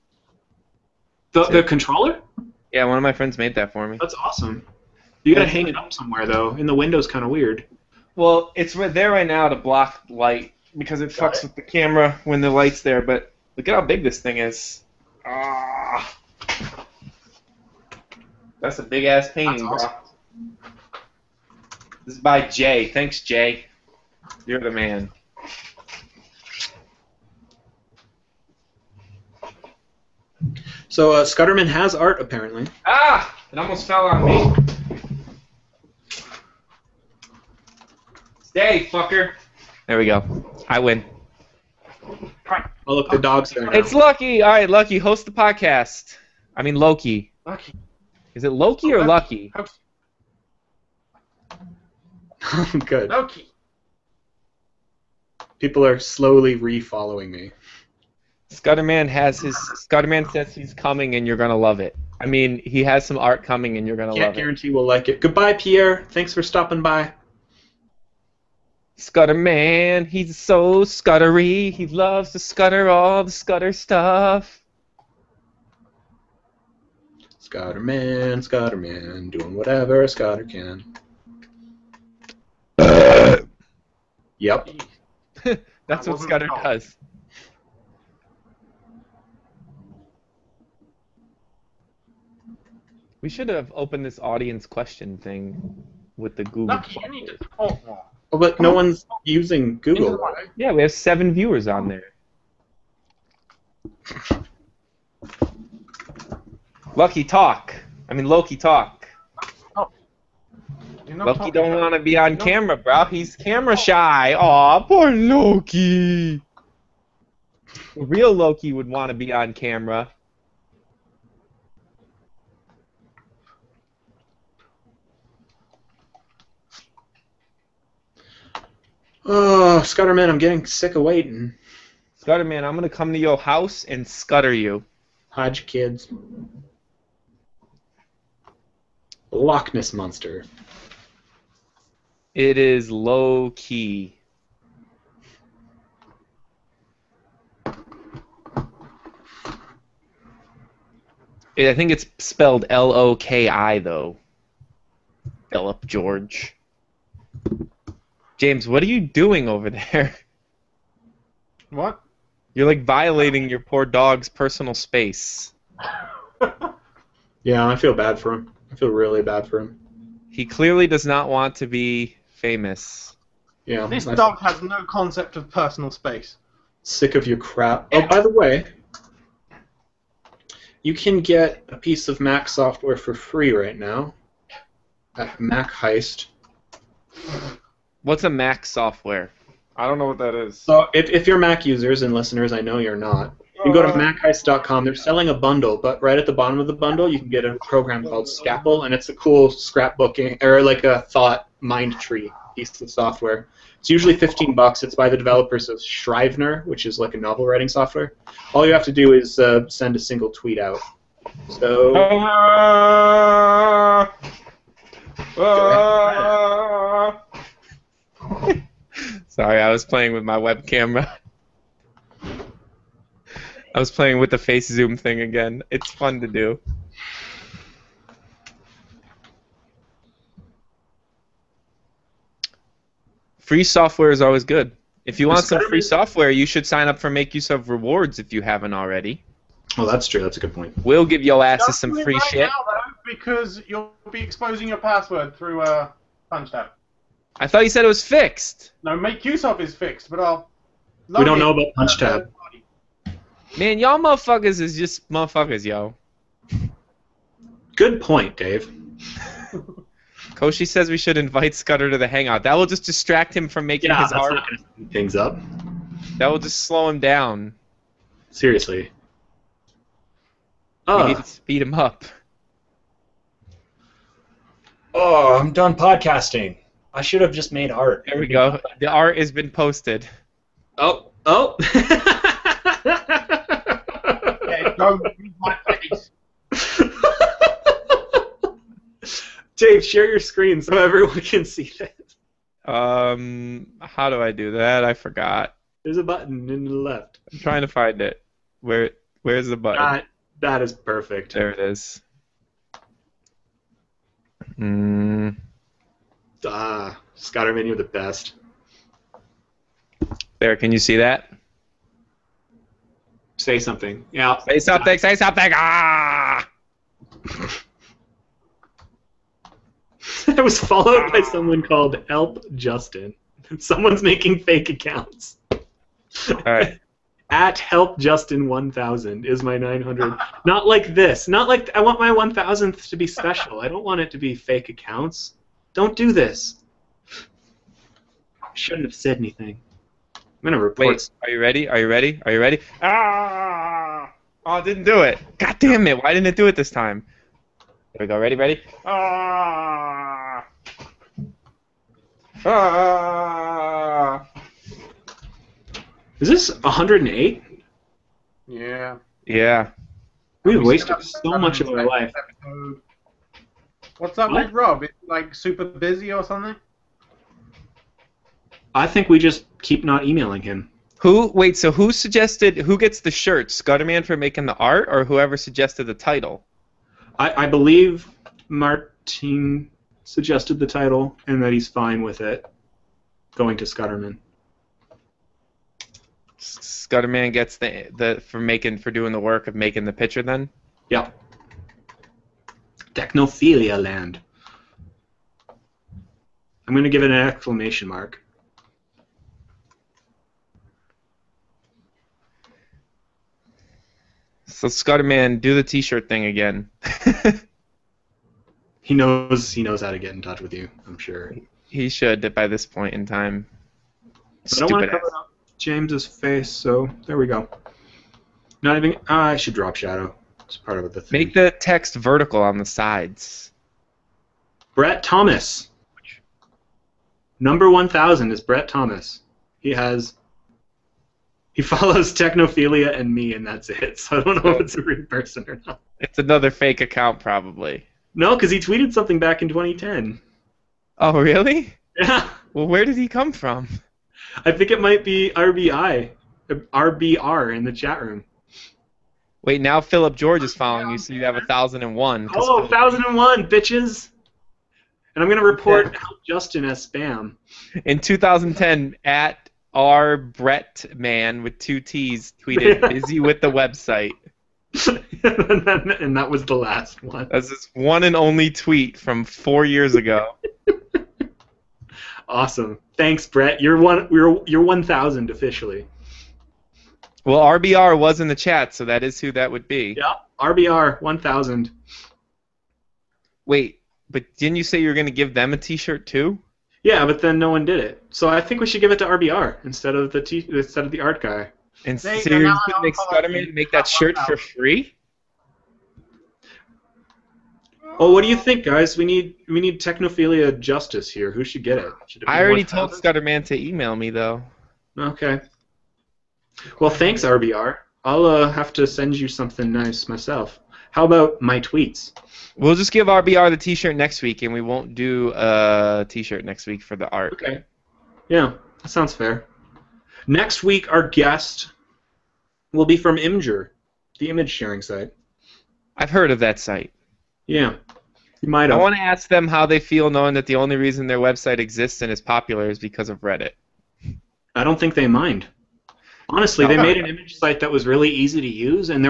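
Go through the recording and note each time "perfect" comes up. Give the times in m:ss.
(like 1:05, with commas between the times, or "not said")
5:00.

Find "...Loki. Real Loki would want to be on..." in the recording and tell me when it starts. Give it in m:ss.
1:55.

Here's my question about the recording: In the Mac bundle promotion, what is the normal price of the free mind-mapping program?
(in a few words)
15 bucks.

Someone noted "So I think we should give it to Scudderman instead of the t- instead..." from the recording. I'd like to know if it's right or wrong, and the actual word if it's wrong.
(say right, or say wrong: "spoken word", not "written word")
wrong: "RBR", not "Scudderman".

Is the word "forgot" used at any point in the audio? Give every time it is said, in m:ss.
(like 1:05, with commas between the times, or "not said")
4:54.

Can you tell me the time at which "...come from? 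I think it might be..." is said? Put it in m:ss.
7:23.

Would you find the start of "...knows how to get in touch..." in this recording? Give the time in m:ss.
6:49.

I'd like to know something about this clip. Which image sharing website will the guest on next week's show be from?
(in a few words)
Imgur.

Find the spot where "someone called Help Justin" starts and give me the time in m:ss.
5:21.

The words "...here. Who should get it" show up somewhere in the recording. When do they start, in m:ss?
8:21.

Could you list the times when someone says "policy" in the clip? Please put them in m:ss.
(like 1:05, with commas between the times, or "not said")
not said.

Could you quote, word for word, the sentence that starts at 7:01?
Make the text vertical on the sides.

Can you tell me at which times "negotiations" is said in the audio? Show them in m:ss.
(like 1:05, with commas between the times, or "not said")
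not said.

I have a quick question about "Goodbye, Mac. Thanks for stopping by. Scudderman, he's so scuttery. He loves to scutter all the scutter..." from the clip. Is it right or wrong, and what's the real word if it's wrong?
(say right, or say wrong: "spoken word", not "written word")
wrong: "Pierre", not "Mac".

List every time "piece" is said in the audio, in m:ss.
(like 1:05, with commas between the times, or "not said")
3:01, 3:22.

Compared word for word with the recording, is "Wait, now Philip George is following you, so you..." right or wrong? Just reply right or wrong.
right.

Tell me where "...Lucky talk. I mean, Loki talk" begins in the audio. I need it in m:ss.
1:46.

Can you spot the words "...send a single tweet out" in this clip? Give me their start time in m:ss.
3:29.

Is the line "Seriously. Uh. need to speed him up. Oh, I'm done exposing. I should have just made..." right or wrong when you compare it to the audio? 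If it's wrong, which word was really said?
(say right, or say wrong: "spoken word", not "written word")
wrong: "podcasting", not "exposing".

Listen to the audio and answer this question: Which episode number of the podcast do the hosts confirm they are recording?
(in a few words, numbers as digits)
108.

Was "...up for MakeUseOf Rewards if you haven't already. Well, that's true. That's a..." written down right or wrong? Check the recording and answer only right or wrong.
right.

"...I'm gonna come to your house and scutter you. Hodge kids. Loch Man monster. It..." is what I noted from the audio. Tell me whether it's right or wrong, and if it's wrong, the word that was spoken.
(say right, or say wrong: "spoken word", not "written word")
wrong: "Ness", not "Man".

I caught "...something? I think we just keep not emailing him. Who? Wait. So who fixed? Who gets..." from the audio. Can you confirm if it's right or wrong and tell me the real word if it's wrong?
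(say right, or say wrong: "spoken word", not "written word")
wrong: "suggested", not "fixed".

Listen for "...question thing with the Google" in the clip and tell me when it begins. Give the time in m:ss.
1:34.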